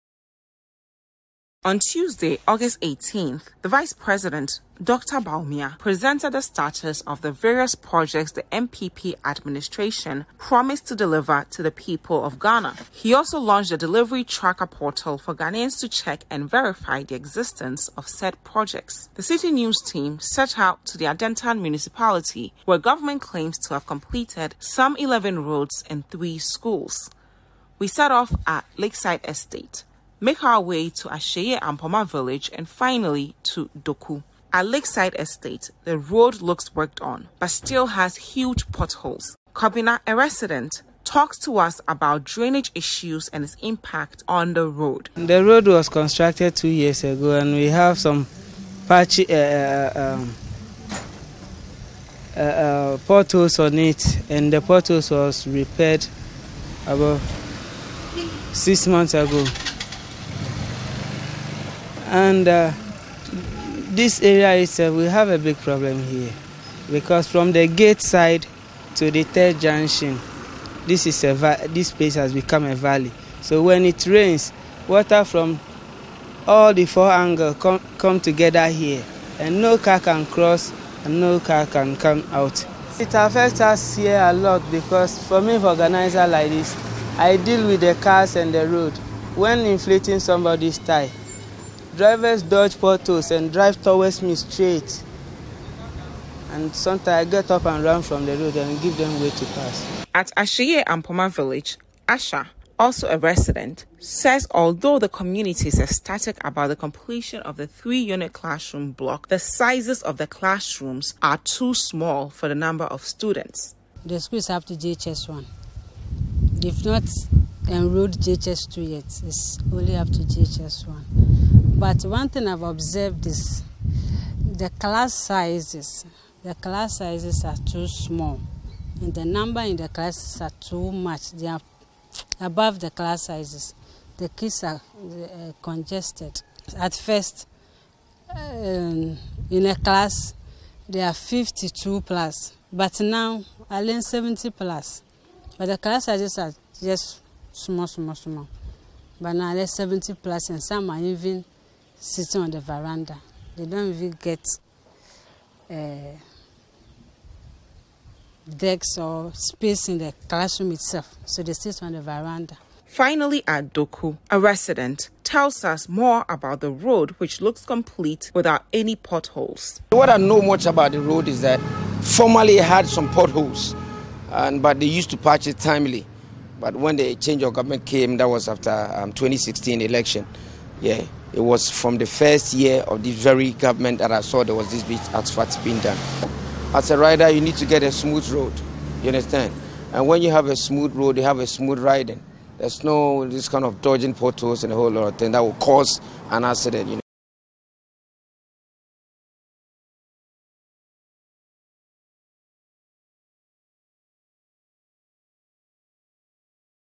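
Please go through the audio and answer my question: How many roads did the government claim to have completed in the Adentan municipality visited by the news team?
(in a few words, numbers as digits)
11.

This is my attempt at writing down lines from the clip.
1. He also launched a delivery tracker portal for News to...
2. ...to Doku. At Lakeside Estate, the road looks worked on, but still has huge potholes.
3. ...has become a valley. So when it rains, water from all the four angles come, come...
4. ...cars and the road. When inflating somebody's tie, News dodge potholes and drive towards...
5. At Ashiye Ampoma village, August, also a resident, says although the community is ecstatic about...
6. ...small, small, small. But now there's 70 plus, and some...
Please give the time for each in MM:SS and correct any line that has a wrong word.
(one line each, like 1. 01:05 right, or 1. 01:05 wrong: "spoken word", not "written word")
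1. 00:12 wrong: "Ghanaians", not "News"
2. 00:33 right
3. 01:12 right
4. 01:28 wrong: "Drivers", not "News"
5. 01:40 wrong: "Asha", not "August"
6. 02:27 right.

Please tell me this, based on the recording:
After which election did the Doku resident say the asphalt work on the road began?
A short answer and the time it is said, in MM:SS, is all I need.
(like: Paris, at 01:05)
2016, at 02:59.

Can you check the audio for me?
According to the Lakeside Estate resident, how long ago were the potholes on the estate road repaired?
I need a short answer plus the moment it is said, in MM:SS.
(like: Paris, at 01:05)
About 6 months ago, at 00:56.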